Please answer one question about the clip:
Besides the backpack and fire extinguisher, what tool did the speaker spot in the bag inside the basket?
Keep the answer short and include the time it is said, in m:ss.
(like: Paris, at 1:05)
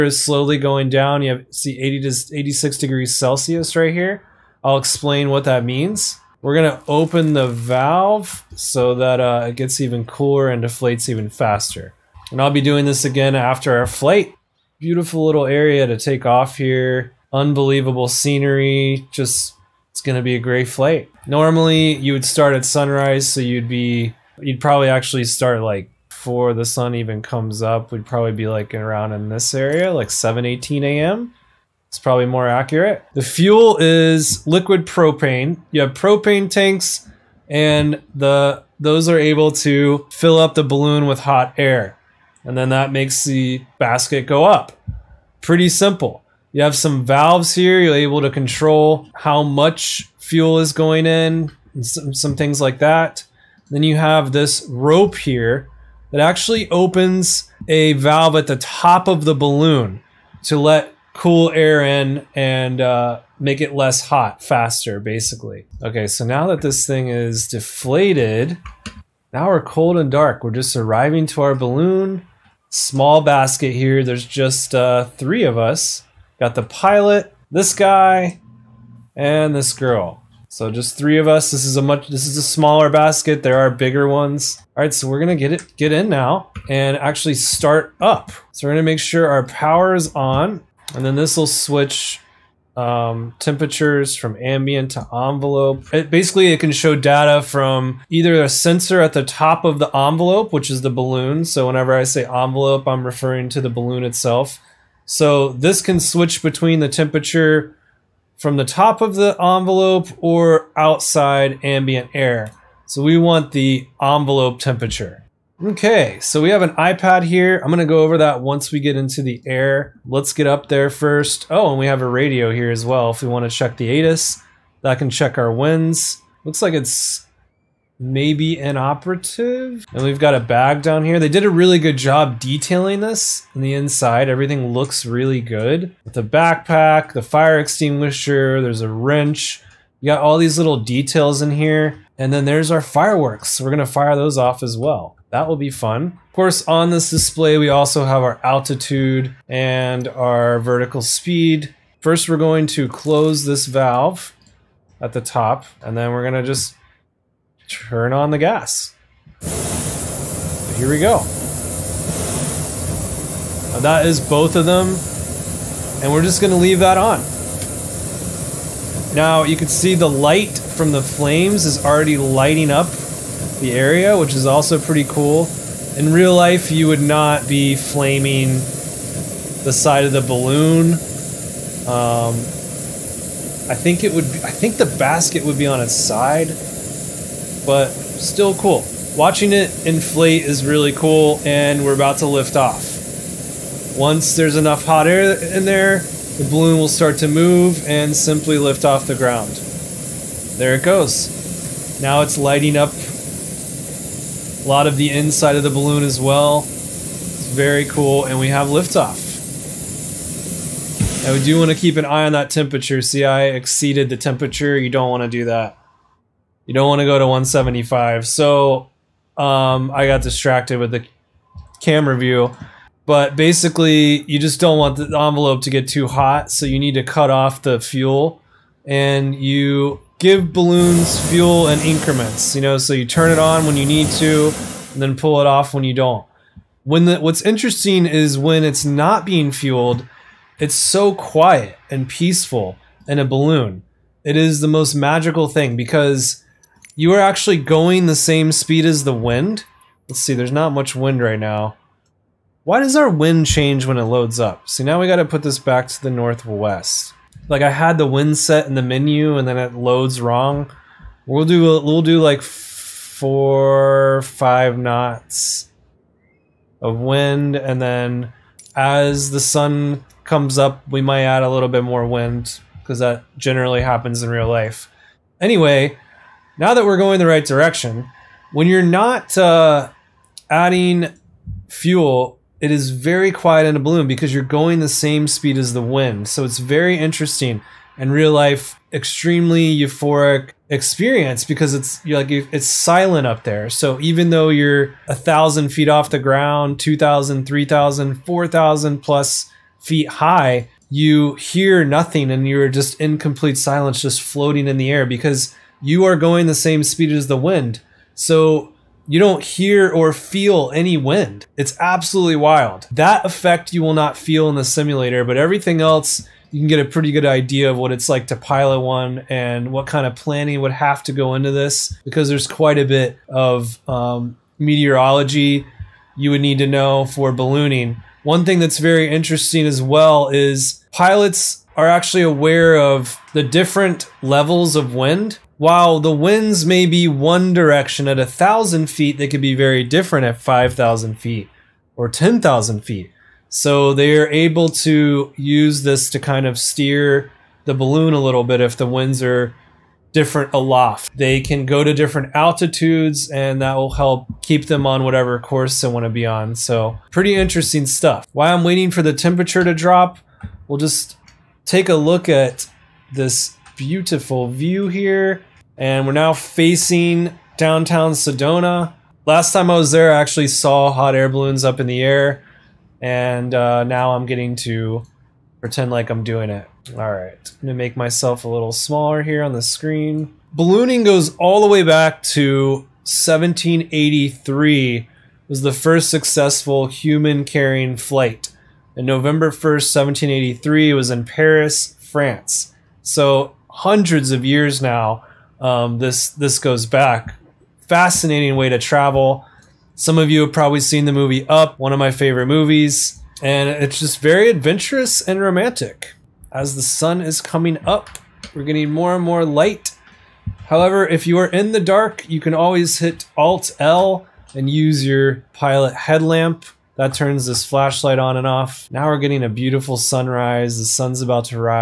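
a wrench, at 2:18.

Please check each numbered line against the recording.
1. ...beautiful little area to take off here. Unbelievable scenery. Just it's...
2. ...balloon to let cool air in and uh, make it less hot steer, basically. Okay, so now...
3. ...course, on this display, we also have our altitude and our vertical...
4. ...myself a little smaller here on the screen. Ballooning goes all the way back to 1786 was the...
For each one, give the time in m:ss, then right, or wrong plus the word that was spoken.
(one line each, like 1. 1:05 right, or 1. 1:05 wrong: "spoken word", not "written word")
1. 0:14 right
2. 0:59 wrong: "faster", not "steer"
3. 2:26 right
4. 6:17 wrong: "1783", not "1786".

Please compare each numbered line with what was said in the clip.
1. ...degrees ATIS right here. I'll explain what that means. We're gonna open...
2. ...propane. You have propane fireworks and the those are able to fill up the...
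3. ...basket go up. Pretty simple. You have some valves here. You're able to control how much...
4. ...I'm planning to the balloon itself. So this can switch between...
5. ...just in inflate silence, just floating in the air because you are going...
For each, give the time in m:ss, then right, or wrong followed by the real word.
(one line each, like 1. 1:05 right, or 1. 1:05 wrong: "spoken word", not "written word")
1. 0:02 wrong: "Celsius", not "ATIS"
2. 0:34 wrong: "tanks", not "fireworks"
3. 0:43 right
4. 1:42 wrong: "referring", not "planning"
5. 5:02 wrong: "complete", not "inflate".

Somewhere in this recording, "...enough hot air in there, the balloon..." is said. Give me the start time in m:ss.
3:14.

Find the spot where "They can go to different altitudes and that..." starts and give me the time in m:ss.
5:51.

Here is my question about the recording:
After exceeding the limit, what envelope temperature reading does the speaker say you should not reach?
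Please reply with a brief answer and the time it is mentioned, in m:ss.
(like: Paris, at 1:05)
175, at 3:37.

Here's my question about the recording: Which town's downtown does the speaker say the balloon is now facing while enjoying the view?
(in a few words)
Sedona.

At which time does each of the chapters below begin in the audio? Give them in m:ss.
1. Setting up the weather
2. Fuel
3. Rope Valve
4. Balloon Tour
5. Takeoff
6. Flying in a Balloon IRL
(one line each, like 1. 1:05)
1. 0:20
2. 0:31
3. 0:53
4. 1:08
5. 2:38
6. 4:35.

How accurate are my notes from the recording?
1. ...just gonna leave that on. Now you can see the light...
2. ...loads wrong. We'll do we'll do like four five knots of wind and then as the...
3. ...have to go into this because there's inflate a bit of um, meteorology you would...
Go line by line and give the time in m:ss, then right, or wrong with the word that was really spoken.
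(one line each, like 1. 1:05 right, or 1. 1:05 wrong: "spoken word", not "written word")
1. 2:46 right
2. 4:19 right
3. 5:20 wrong: "quite", not "inflate".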